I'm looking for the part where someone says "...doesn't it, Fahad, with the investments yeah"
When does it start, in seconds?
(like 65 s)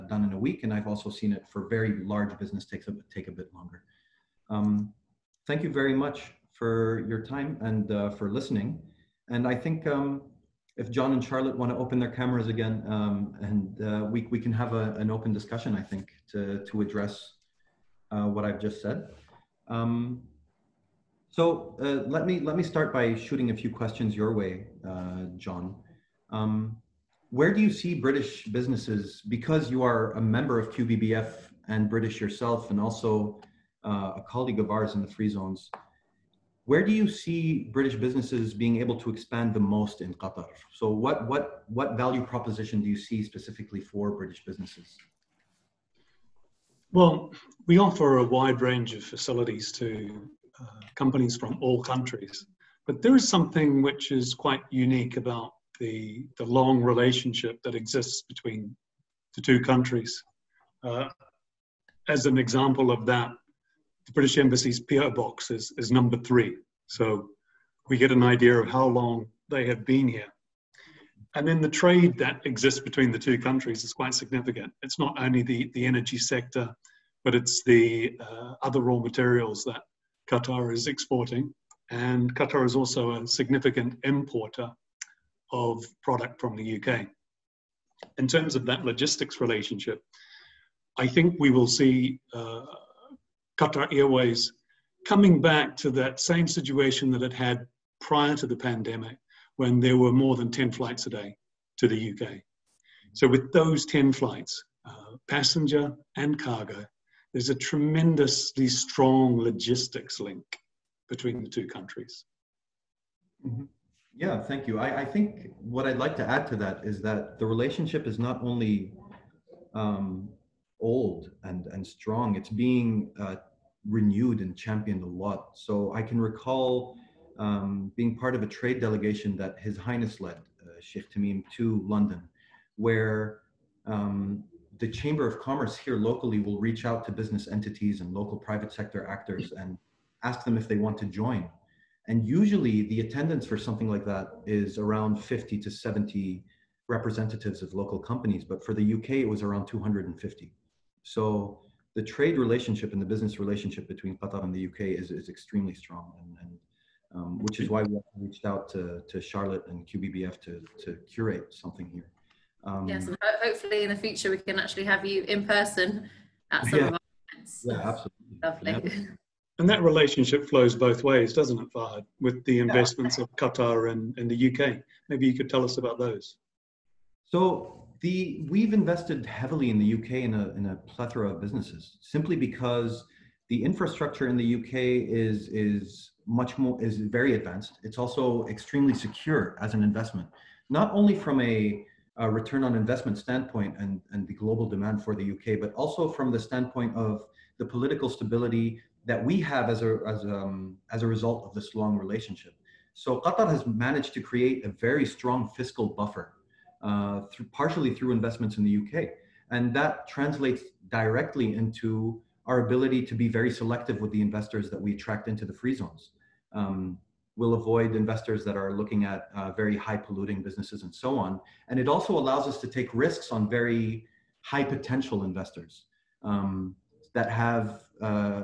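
171 s.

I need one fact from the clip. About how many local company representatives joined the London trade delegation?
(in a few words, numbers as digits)
250.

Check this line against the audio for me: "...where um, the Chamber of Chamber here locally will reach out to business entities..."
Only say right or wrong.
wrong.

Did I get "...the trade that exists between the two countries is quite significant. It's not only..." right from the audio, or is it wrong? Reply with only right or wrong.
right.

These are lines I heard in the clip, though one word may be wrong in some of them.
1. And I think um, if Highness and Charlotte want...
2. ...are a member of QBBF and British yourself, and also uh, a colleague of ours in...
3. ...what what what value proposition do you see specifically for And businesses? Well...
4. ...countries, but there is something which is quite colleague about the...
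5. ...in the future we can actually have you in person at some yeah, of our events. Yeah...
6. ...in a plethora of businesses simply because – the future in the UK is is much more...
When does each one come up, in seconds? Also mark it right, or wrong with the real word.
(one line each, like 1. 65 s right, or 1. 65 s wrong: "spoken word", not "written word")
1. 9 s wrong: "John", not "Highness"
2. 29 s right
3. 40 s wrong: "British", not "And"
4. 51 s wrong: "unique", not "colleague"
5. 163 s right
6. 180 s wrong: "infrastructure", not "future".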